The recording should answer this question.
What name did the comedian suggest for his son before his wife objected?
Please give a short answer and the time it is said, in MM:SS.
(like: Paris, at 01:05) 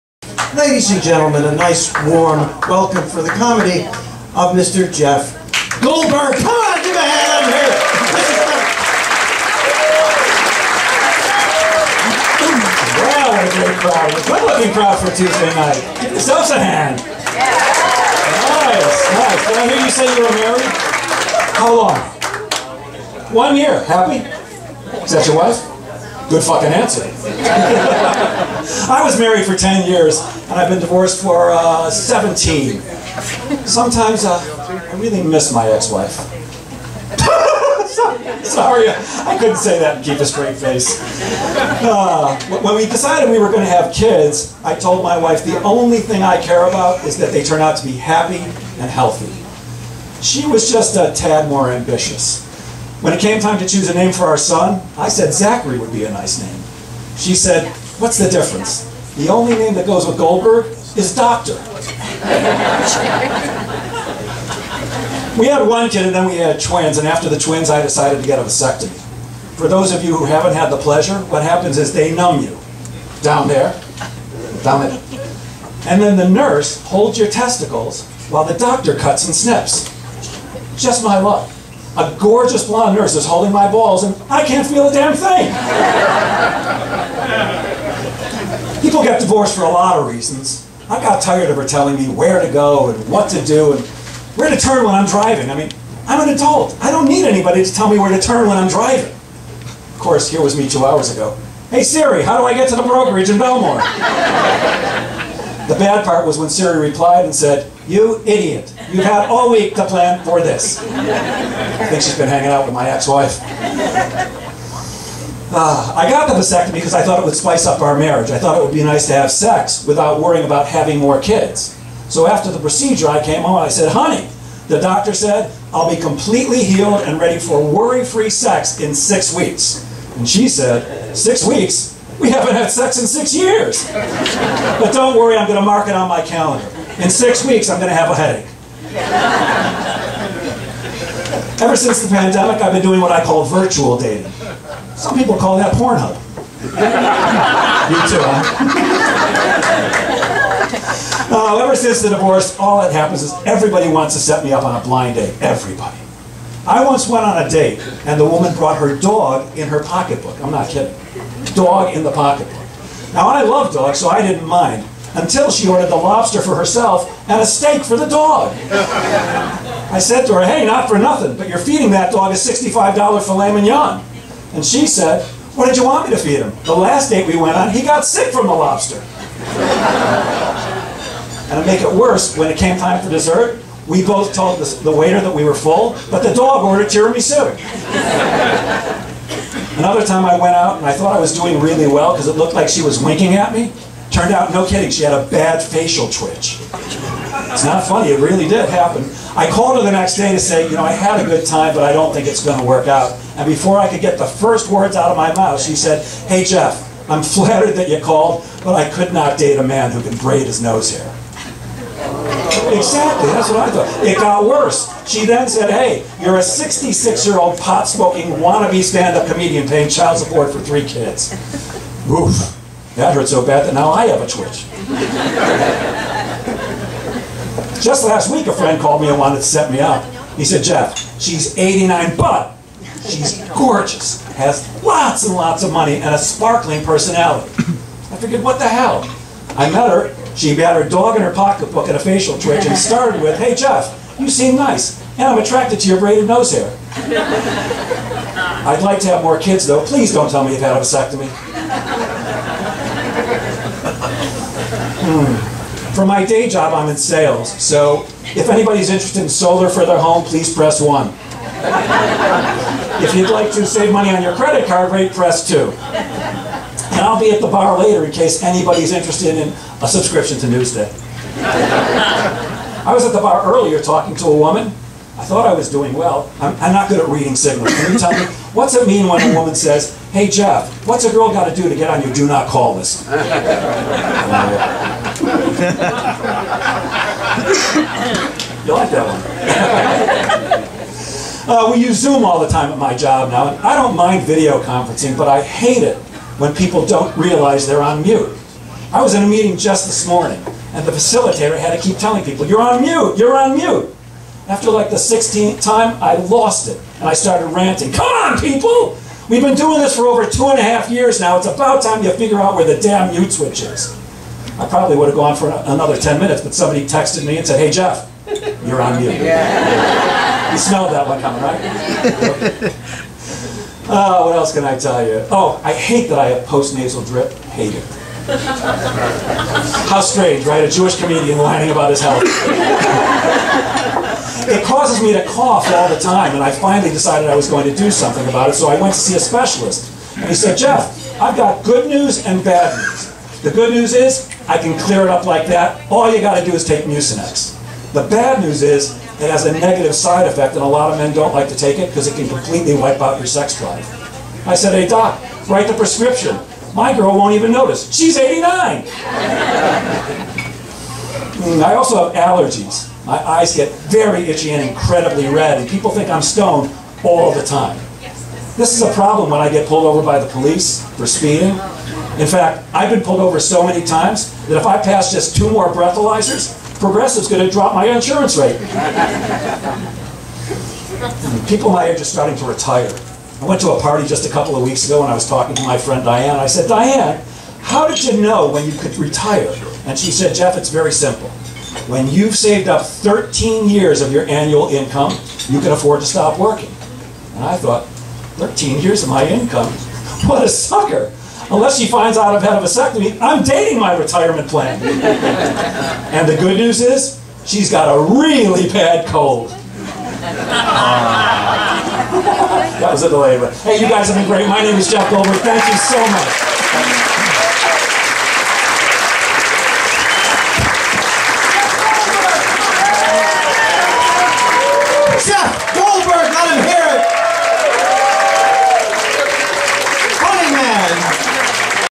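Zachary, at 00:55.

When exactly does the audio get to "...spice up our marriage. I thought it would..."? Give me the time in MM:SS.
01:57.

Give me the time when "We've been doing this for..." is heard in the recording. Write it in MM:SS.
05:09.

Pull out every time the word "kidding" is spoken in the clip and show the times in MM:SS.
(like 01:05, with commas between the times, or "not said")
02:40, 03:14.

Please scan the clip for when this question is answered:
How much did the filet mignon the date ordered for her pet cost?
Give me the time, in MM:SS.
02:52.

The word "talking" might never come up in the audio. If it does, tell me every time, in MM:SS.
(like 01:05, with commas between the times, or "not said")
04:33, 06:25.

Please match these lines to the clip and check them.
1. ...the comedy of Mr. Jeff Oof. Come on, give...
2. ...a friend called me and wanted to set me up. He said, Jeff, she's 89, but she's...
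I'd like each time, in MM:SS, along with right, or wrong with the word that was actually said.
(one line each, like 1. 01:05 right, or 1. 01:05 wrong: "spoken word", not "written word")
1. 00:03 wrong: "Goldberg", not "Oof"
2. 03:48 right.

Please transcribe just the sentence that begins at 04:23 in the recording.
if you'd like to save money on your credit card rate, press two.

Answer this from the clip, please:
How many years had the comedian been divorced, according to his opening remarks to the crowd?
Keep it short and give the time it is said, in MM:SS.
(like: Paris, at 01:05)
17, at 00:31.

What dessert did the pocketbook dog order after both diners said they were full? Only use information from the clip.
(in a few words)
Tiramisu.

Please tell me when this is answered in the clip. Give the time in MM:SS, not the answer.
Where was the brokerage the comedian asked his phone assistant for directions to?
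01:43.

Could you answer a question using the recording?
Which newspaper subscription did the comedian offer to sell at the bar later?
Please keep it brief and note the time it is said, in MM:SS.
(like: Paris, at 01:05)
Newsday, at 04:30.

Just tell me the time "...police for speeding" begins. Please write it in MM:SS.
06:10.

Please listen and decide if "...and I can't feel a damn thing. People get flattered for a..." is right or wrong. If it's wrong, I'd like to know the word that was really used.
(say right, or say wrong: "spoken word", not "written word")
wrong: "divorced", not "flattered".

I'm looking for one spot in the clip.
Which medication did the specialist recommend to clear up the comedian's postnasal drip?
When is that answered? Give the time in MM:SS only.
05:46.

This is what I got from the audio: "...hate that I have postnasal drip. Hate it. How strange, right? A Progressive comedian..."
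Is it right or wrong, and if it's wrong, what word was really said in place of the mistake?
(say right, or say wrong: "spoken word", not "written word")
wrong: "Jewish", not "Progressive".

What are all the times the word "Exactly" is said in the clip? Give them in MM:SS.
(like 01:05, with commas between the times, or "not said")
03:32.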